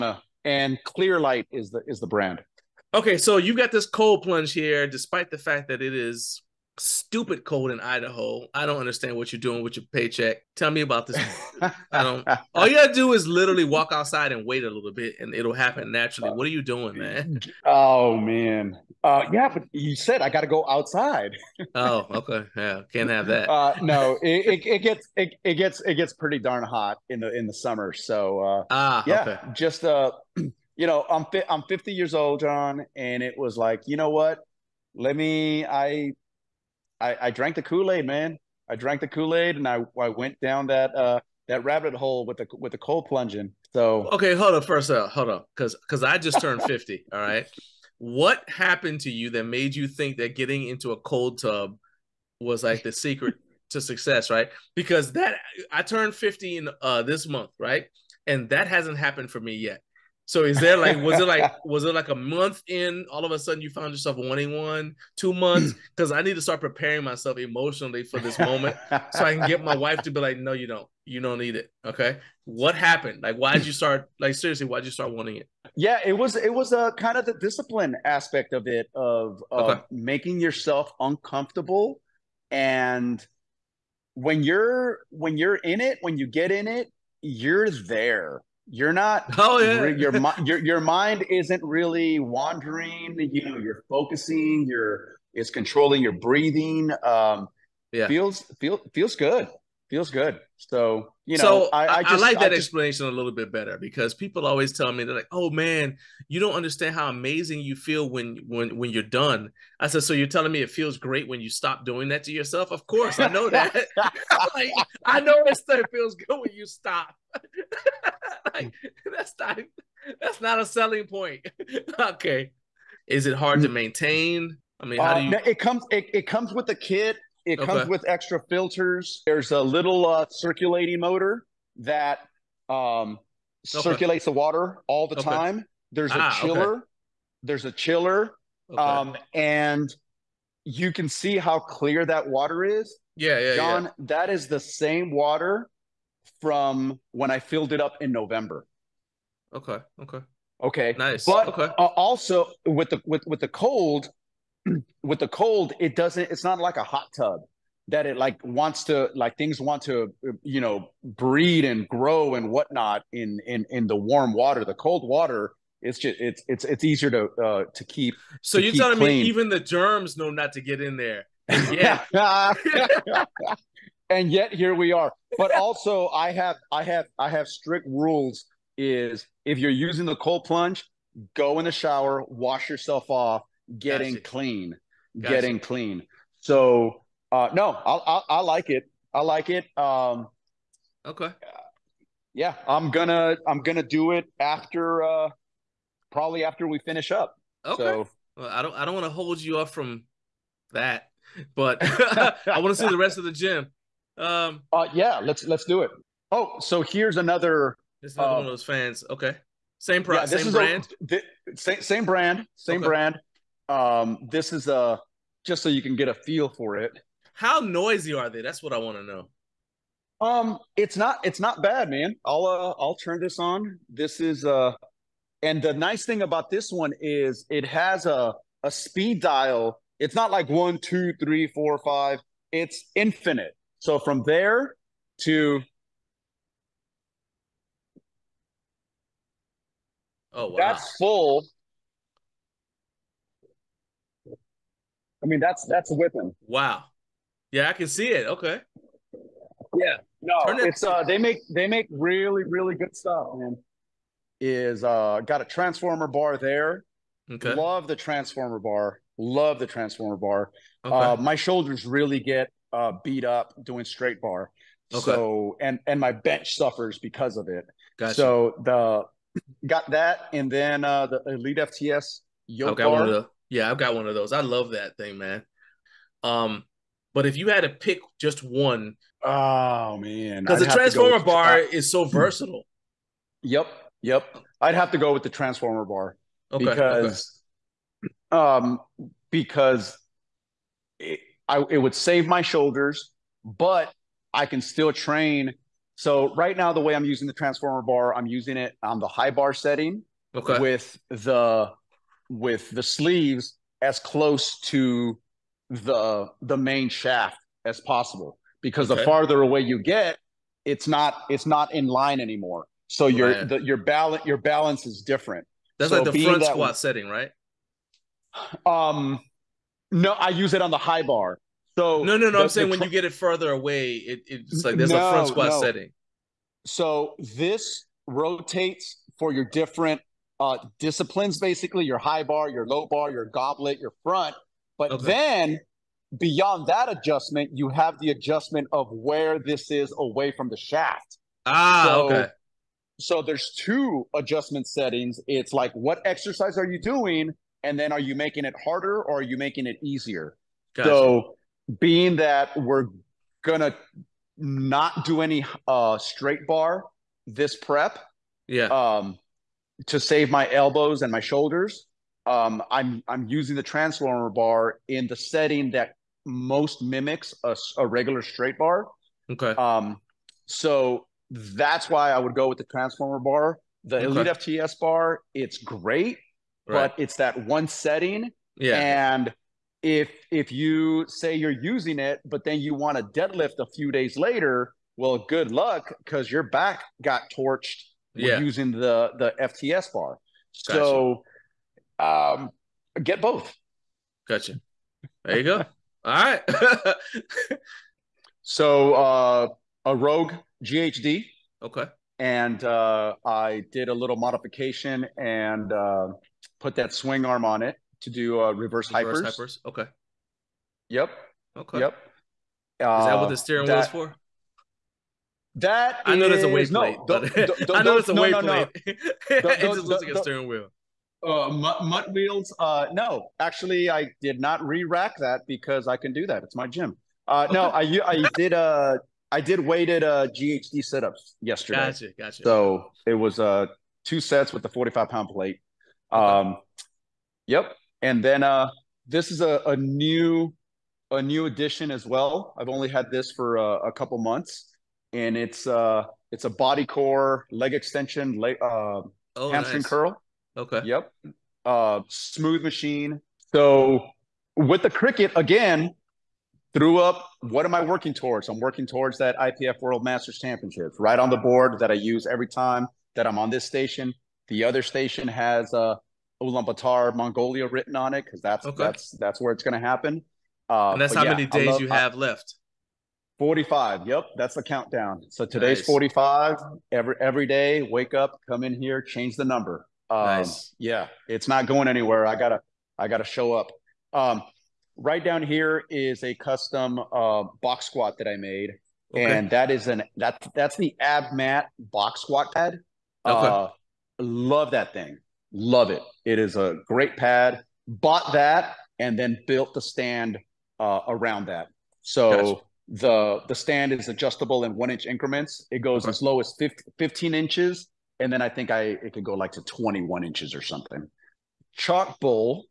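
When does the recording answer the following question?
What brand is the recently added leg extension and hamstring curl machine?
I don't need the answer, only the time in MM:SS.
07:26.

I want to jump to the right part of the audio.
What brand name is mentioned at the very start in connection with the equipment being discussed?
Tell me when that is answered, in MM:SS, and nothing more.
00:00.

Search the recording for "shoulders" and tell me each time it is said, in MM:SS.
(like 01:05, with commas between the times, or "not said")
04:21, 04:52, 06:01.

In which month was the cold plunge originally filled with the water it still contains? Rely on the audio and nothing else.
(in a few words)
November.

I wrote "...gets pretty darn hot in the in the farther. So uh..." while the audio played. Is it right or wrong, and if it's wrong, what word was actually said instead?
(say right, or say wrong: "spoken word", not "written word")
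wrong: "summer", not "farther".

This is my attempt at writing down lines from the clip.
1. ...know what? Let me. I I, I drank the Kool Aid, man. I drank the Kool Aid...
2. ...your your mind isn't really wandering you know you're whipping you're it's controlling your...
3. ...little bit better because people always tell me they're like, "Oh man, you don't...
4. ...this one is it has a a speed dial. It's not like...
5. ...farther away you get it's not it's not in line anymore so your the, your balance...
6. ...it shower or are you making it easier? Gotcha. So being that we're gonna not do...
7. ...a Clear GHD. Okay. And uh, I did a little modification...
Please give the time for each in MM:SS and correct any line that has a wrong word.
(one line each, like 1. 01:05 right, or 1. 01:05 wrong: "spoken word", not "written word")
1. 00:33 right
2. 01:30 wrong: "focusing", not "whipping"
3. 01:43 right
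4. 03:46 right
5. 05:09 right
6. 05:48 wrong: "harder", not "shower"
7. 06:39 wrong: "Rogue", not "Clear".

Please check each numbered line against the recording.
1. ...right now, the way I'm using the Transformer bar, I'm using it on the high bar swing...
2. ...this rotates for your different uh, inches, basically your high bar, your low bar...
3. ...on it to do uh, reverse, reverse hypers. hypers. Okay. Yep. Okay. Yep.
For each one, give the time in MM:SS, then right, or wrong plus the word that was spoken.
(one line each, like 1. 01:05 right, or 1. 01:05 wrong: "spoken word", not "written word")
1. 04:56 wrong: "setting", not "swing"
2. 05:27 wrong: "disciplines", not "inches"
3. 06:47 right.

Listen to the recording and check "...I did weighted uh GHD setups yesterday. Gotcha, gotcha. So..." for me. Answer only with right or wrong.
right.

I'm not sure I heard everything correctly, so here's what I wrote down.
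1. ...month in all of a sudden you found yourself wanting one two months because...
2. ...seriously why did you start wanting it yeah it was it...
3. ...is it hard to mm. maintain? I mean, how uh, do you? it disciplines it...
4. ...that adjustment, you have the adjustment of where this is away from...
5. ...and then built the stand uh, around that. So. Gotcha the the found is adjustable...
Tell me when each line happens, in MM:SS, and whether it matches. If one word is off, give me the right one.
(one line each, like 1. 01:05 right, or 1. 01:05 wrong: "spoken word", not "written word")
1. 01:02 right
2. 01:14 right
3. 02:03 wrong: "comes", not "disciplines"
4. 05:36 right
5. 08:18 wrong: "stand", not "found".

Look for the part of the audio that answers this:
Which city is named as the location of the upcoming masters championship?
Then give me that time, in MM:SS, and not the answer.
07:46.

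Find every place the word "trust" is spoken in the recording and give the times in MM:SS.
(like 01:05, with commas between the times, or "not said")
not said.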